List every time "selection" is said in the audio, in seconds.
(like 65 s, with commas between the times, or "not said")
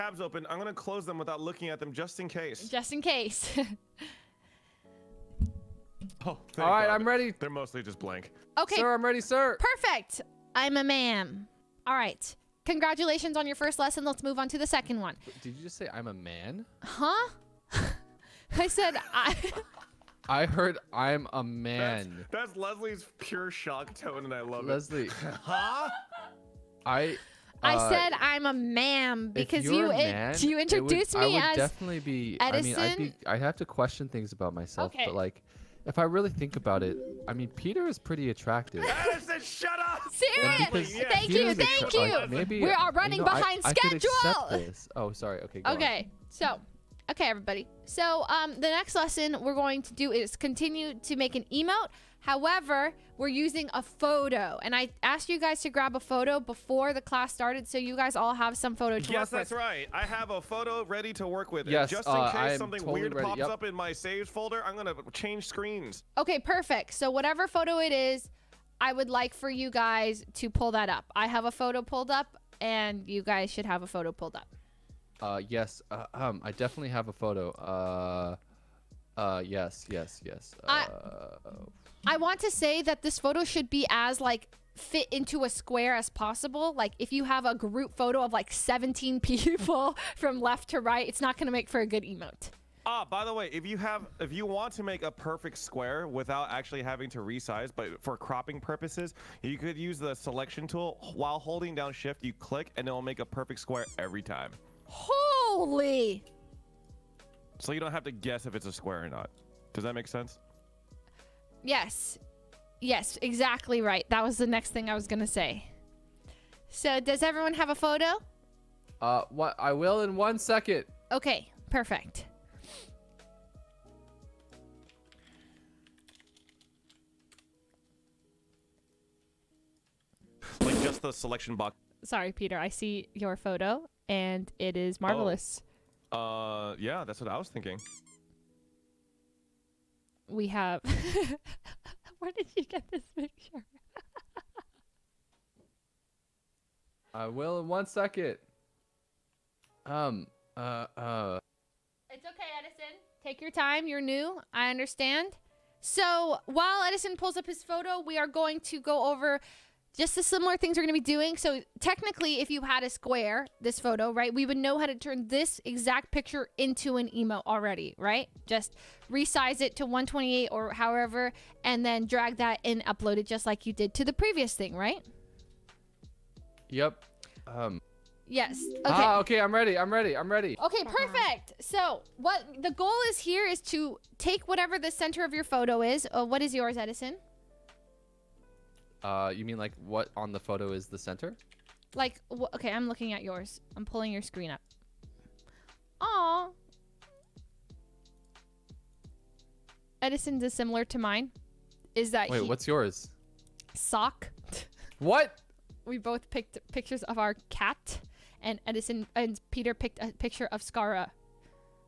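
100 s, 131 s.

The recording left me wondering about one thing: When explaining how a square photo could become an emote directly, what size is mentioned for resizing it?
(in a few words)
128.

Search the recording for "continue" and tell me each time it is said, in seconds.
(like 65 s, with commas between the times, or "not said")
50 s.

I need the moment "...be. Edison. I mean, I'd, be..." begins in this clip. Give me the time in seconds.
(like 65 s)
31 s.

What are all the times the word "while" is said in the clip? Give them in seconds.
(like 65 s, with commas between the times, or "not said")
101 s, 156 s.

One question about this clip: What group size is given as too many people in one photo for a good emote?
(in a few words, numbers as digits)
17.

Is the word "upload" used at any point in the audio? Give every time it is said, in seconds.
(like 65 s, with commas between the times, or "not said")
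172 s.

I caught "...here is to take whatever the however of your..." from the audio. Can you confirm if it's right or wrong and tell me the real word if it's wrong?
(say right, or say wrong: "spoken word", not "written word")
wrong: "center", not "however".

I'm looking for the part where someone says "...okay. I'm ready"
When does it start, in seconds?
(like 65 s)
179 s.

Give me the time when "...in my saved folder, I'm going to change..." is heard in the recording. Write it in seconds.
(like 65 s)
63 s.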